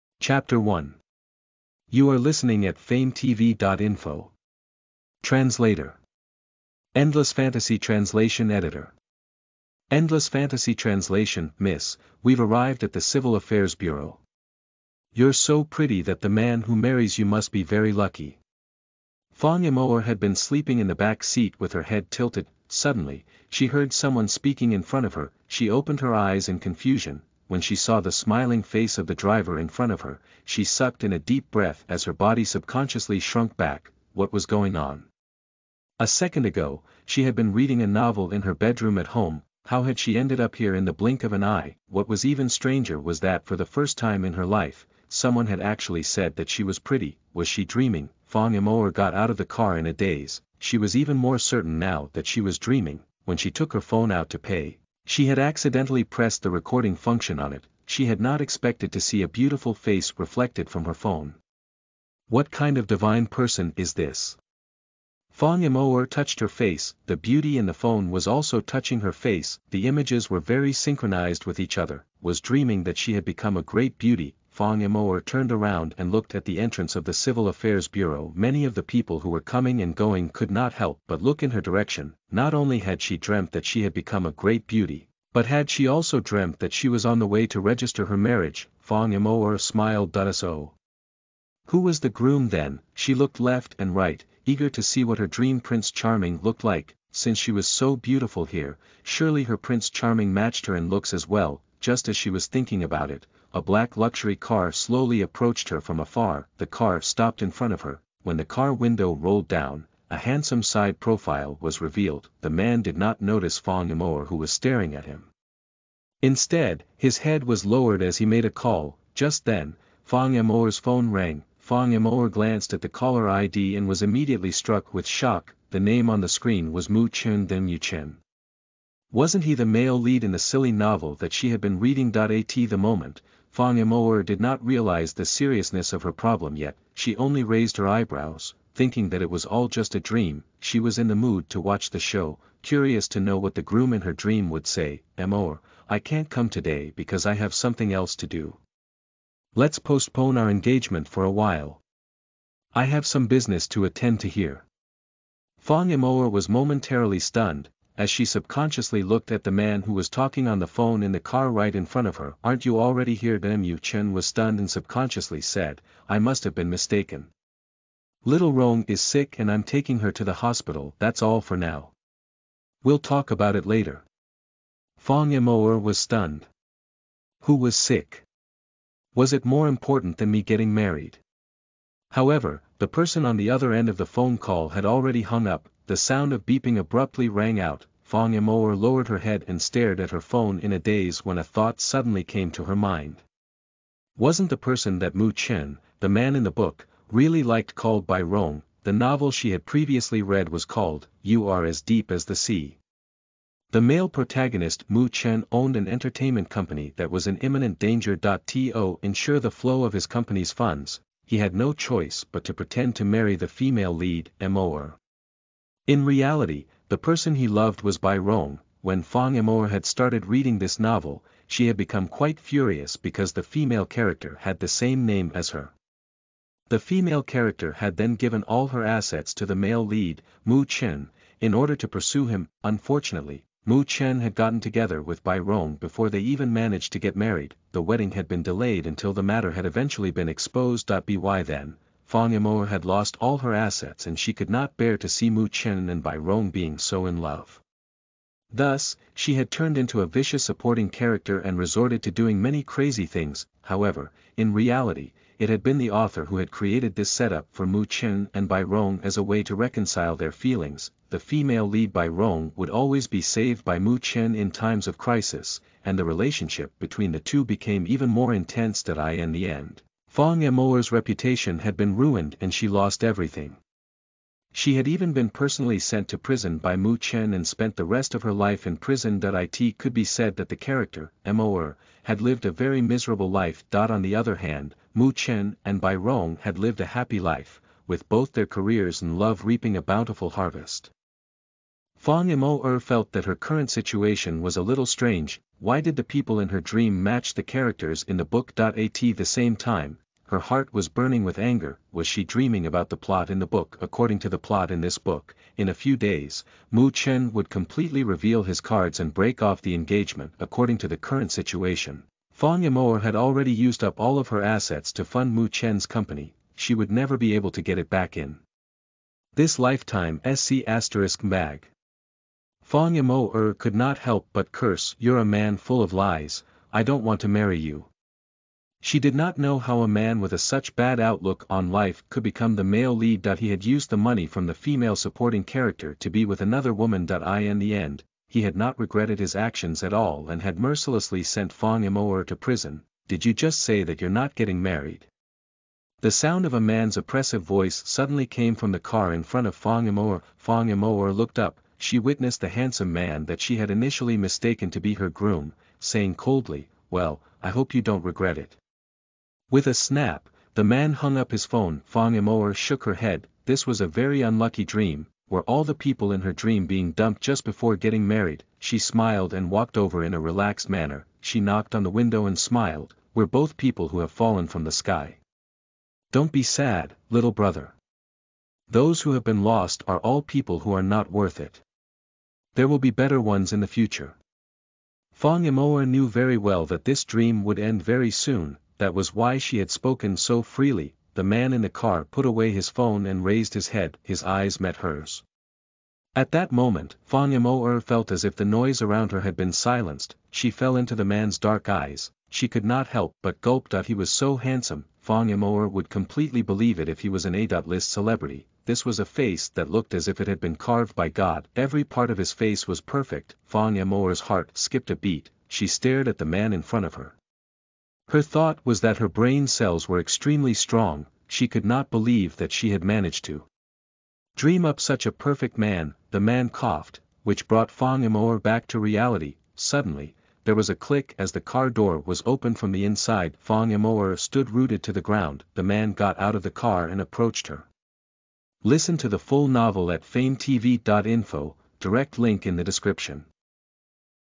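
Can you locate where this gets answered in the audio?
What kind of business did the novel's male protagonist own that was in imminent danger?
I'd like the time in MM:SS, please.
03:25.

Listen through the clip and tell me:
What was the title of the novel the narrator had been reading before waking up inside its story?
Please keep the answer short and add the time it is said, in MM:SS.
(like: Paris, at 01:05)
You Are As Deep As the Sea, at 03:21.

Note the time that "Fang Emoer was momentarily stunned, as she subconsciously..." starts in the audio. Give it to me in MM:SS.
02:35.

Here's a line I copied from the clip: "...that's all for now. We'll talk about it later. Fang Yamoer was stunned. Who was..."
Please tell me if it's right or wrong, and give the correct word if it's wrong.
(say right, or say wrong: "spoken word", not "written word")
right.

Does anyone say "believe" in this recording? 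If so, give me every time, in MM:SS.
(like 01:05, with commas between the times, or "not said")
06:46, 07:01.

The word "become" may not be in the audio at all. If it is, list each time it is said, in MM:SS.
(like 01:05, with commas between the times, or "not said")
01:13, 01:23, 03:41, 05:32.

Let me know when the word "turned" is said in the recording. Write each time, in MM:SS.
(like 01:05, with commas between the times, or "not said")
01:15, 04:09.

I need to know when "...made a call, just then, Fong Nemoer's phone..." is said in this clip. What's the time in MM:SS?
01:58.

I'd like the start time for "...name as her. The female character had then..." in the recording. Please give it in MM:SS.
03:45.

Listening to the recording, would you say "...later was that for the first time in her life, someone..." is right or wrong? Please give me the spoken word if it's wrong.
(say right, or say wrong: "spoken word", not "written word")
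wrong: "stranger", not "later".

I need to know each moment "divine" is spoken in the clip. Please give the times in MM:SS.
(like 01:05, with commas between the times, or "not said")
01:02.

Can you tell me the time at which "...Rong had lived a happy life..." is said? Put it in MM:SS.
04:45.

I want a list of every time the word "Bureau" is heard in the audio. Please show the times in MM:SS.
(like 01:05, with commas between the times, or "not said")
00:13, 01:17.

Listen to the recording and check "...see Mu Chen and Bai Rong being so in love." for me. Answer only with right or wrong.
right.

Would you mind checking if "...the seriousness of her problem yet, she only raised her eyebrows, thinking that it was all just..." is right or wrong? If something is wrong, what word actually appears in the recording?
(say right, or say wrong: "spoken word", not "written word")
right.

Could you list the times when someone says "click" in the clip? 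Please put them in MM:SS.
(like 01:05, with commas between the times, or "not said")
07:10.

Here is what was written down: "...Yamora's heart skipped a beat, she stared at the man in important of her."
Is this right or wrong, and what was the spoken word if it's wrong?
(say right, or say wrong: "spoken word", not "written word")
wrong: "front", not "important".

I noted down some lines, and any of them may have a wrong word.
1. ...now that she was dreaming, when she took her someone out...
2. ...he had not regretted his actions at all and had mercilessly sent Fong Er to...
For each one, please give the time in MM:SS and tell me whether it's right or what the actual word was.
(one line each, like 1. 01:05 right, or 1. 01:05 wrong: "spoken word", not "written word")
1. 00:51 wrong: "phone", not "someone"
2. 05:38 right.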